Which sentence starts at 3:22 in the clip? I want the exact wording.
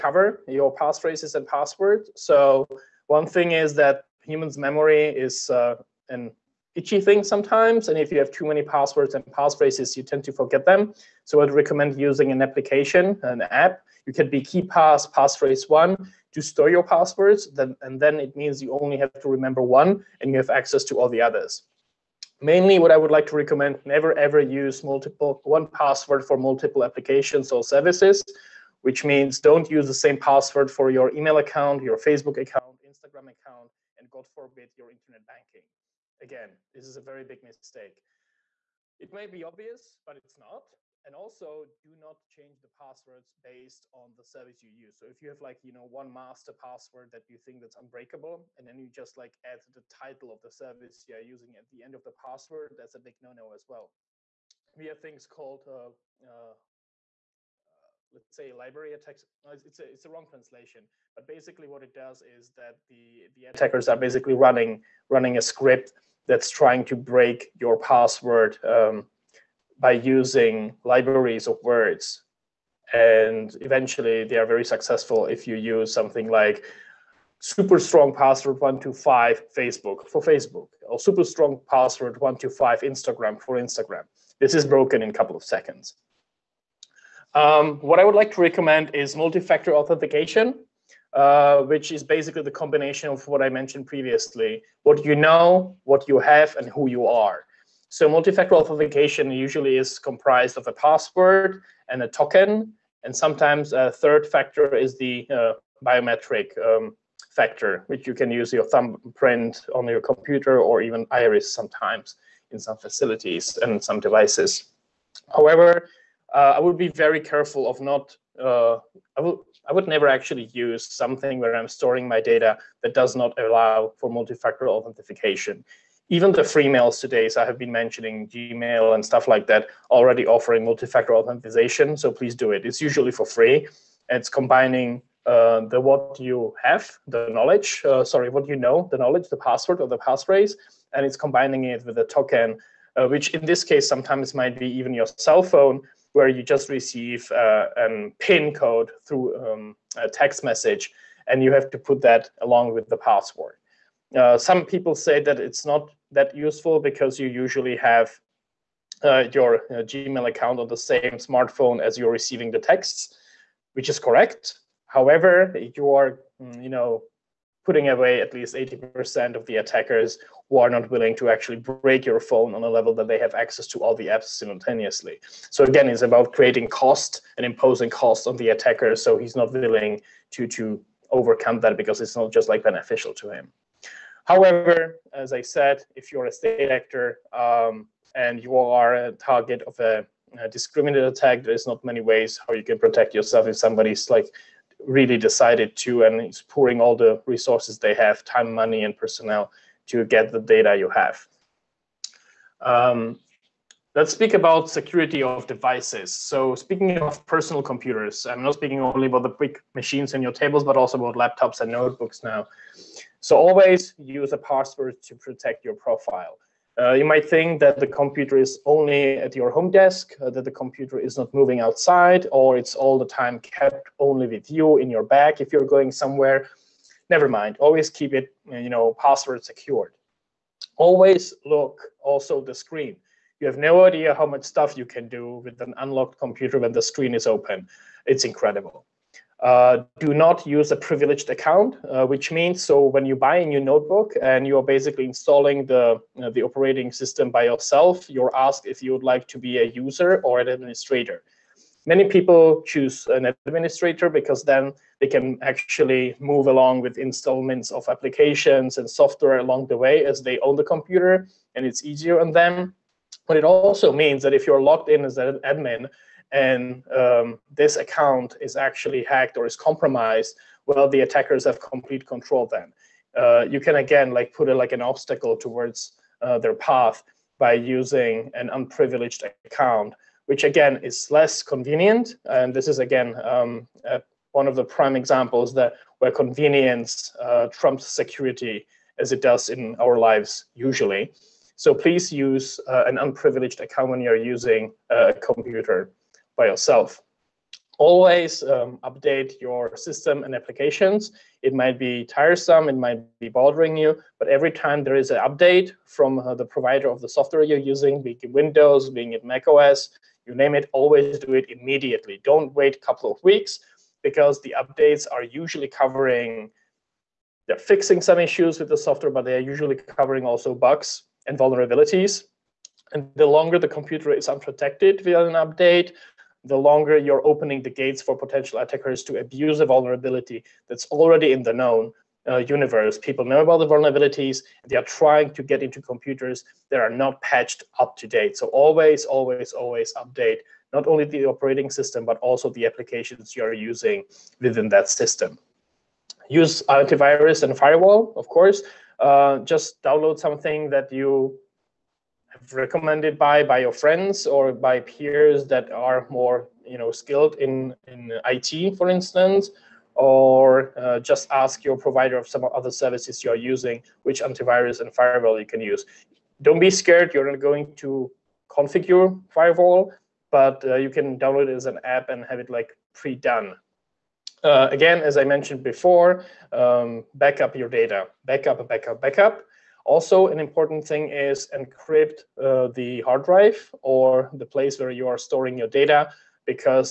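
Um, let's speak about security of devices.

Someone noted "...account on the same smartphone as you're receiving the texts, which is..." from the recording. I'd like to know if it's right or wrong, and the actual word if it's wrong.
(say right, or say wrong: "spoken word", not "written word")
right.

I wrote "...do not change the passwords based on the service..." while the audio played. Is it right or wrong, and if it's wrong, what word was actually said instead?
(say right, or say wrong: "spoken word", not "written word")
right.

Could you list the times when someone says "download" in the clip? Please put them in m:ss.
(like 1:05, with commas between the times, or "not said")
5:49, 6:11.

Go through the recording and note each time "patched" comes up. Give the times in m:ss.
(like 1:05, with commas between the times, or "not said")
5:37.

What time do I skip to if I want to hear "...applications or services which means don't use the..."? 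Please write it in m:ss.
0:26.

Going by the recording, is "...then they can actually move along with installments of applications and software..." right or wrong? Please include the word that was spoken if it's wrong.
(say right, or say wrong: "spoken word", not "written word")
right.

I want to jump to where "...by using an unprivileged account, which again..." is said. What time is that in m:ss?
4:37.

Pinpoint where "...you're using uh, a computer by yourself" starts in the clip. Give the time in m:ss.
4:54.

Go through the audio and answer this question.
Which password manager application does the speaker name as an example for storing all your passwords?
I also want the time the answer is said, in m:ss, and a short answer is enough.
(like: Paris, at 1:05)
KeePass, at 0:14.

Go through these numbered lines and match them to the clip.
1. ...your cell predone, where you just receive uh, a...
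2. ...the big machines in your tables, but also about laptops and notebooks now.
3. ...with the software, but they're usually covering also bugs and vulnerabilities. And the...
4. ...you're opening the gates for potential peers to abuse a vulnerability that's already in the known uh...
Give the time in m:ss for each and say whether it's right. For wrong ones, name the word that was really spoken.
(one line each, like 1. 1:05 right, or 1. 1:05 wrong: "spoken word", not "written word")
1. 2:24 wrong: "phone", not "predone"
2. 3:29 right
3. 5:18 right
4. 5:26 wrong: "attackers", not "peers".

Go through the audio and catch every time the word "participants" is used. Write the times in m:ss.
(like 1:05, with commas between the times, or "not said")
not said.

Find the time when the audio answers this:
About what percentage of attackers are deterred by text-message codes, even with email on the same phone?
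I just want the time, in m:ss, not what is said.
2:48.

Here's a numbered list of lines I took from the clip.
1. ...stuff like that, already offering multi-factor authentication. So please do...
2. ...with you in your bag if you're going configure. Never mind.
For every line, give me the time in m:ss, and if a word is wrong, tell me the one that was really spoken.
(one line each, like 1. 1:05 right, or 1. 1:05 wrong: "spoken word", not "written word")
1. 2:09 right
2. 3:44 wrong: "somewhere", not "configure".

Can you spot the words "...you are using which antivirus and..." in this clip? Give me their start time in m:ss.
6:03.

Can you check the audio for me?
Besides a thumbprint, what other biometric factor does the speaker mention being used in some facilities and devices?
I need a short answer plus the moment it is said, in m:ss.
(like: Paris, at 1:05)
Iris, at 1:51.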